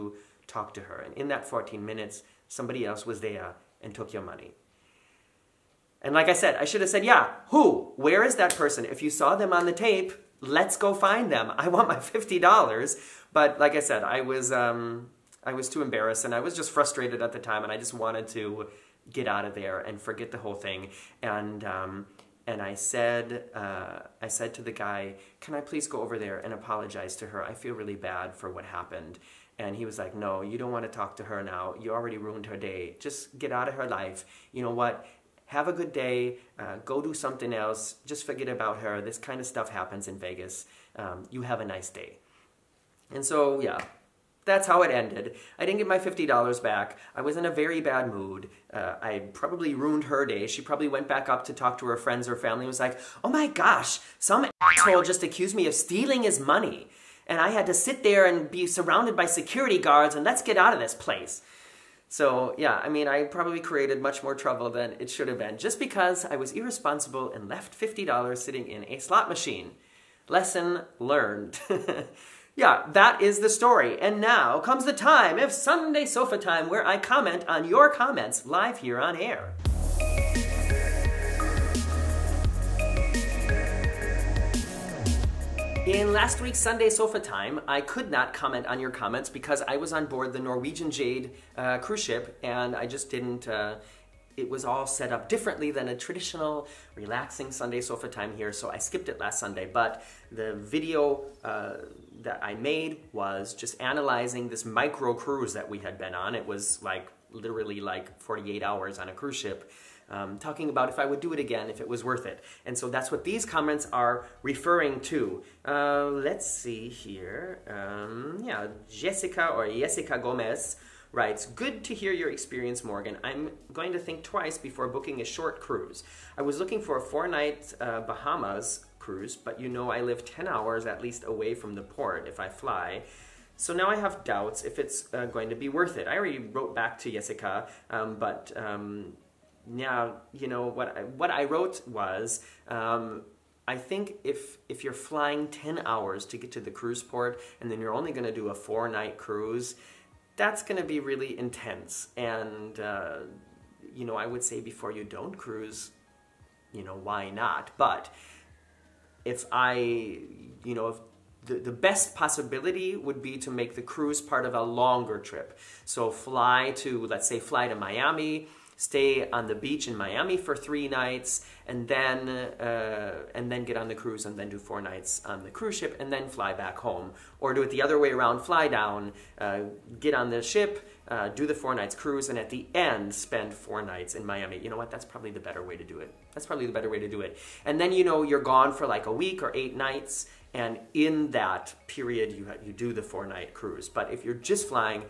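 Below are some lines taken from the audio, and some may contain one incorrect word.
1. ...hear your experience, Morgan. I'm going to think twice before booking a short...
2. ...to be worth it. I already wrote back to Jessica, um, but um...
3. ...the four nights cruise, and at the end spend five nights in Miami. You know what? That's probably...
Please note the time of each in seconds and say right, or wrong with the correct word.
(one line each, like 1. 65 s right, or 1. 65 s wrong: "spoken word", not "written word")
1. 121 s right
2. 135 s right
3. 181 s wrong: "four", not "five".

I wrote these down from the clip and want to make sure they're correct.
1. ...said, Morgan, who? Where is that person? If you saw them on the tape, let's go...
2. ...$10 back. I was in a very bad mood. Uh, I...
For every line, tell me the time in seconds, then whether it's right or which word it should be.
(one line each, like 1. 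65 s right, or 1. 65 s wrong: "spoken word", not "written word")
1. 6 s wrong: "Yeah", not "Morgan"
2. 45 s wrong: "50", not "10".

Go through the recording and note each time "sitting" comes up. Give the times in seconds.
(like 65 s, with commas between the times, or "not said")
68 s.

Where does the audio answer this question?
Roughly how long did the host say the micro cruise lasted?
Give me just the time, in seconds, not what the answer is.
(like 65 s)
108 s.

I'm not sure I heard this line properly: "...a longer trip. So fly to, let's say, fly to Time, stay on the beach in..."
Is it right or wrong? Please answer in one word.
wrong.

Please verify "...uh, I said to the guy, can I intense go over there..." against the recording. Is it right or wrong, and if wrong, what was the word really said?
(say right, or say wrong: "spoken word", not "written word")
wrong: "please", not "intense".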